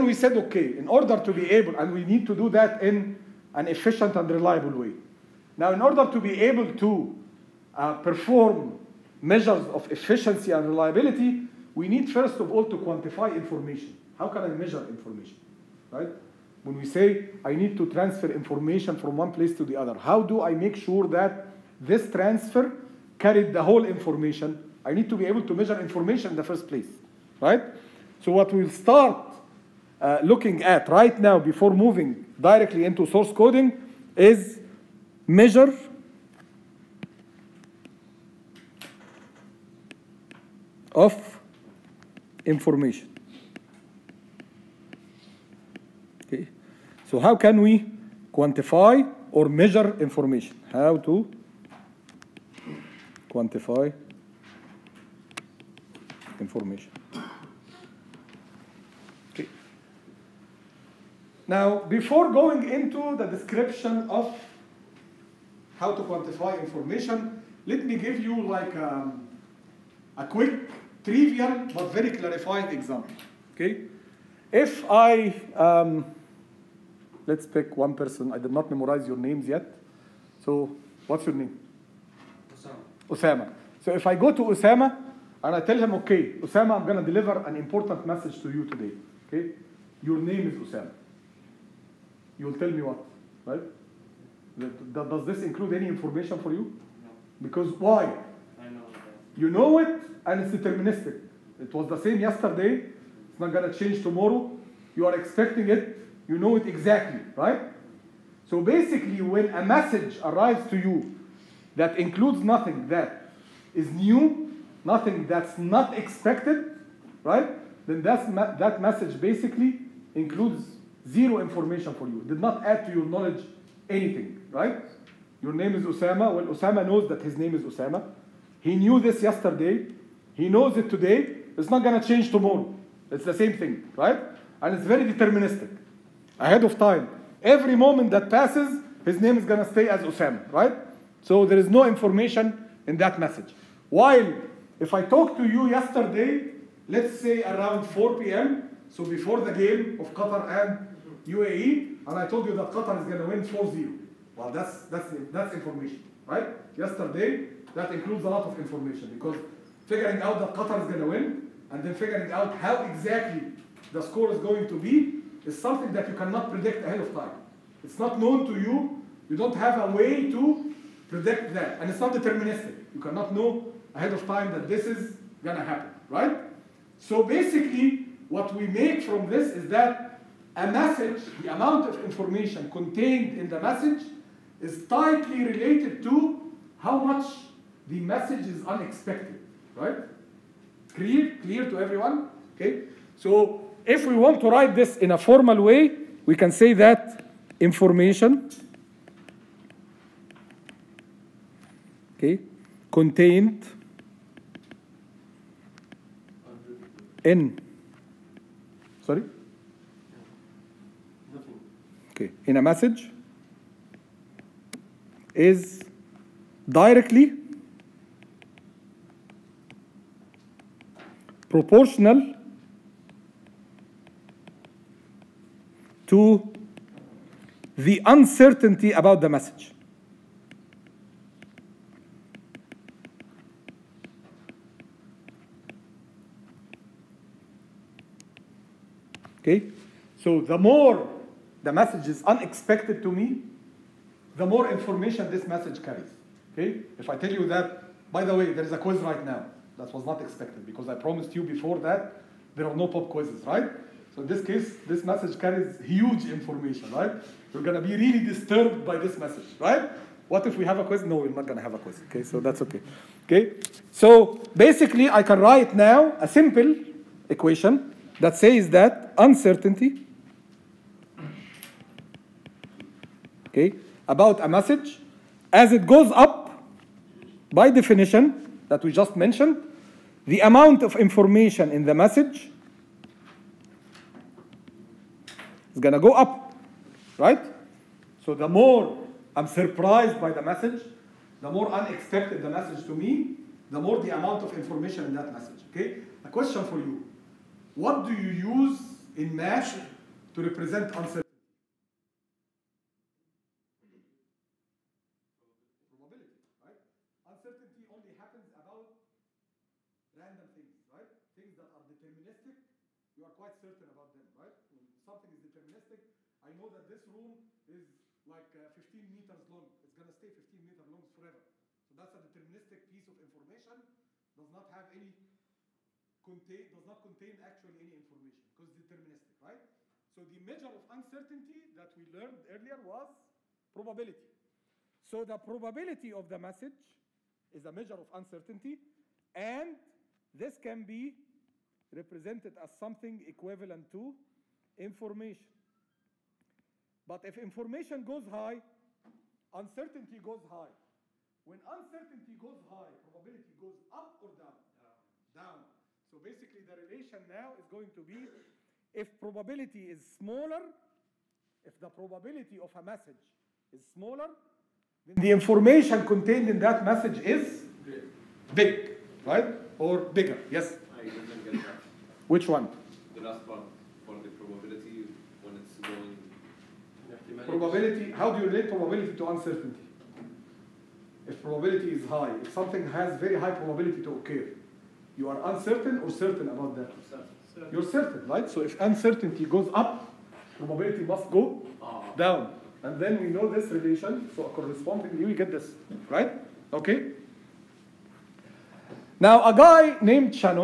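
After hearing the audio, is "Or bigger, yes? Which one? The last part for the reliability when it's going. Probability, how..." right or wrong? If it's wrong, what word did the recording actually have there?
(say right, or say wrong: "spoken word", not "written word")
wrong: "probability", not "reliability".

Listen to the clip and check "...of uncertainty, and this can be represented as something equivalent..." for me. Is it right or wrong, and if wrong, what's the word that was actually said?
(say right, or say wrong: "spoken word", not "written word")
right.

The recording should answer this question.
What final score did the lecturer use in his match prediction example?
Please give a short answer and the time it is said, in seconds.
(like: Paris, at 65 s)
4-0, at 153 s.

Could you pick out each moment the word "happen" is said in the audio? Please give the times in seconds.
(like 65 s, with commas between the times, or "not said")
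175 s, 308 s.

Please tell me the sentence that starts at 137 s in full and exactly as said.
Every moment that passes, his name is going to stay as Osama, right?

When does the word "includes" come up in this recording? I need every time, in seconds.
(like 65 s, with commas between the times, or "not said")
95 s, 111 s, 120 s, 157 s.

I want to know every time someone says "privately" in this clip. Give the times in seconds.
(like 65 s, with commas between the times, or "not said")
not said.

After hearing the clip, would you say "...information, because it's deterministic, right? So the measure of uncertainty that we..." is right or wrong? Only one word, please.
right.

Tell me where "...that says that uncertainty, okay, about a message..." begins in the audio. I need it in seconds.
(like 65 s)
268 s.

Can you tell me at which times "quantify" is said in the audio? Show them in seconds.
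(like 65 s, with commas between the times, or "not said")
12 s, 48 s, 53 s, 66 s.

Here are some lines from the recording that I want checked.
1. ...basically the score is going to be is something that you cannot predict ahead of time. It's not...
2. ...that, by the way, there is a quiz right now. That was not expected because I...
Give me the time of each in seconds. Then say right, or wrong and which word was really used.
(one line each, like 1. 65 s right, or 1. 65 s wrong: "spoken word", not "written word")
1. 162 s wrong: "exactly", not "basically"
2. 247 s right.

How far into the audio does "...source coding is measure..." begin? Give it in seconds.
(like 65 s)
33 s.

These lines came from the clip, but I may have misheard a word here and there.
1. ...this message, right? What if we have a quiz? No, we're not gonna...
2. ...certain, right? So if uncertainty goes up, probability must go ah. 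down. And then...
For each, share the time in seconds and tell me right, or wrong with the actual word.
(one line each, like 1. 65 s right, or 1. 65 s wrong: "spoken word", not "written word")
1. 258 s right
2. 387 s right.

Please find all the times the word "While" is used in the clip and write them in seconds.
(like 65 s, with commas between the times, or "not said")
143 s.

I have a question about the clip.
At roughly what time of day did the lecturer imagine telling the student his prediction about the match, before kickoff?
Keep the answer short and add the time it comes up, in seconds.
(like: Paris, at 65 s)
4 p.m., at 147 s.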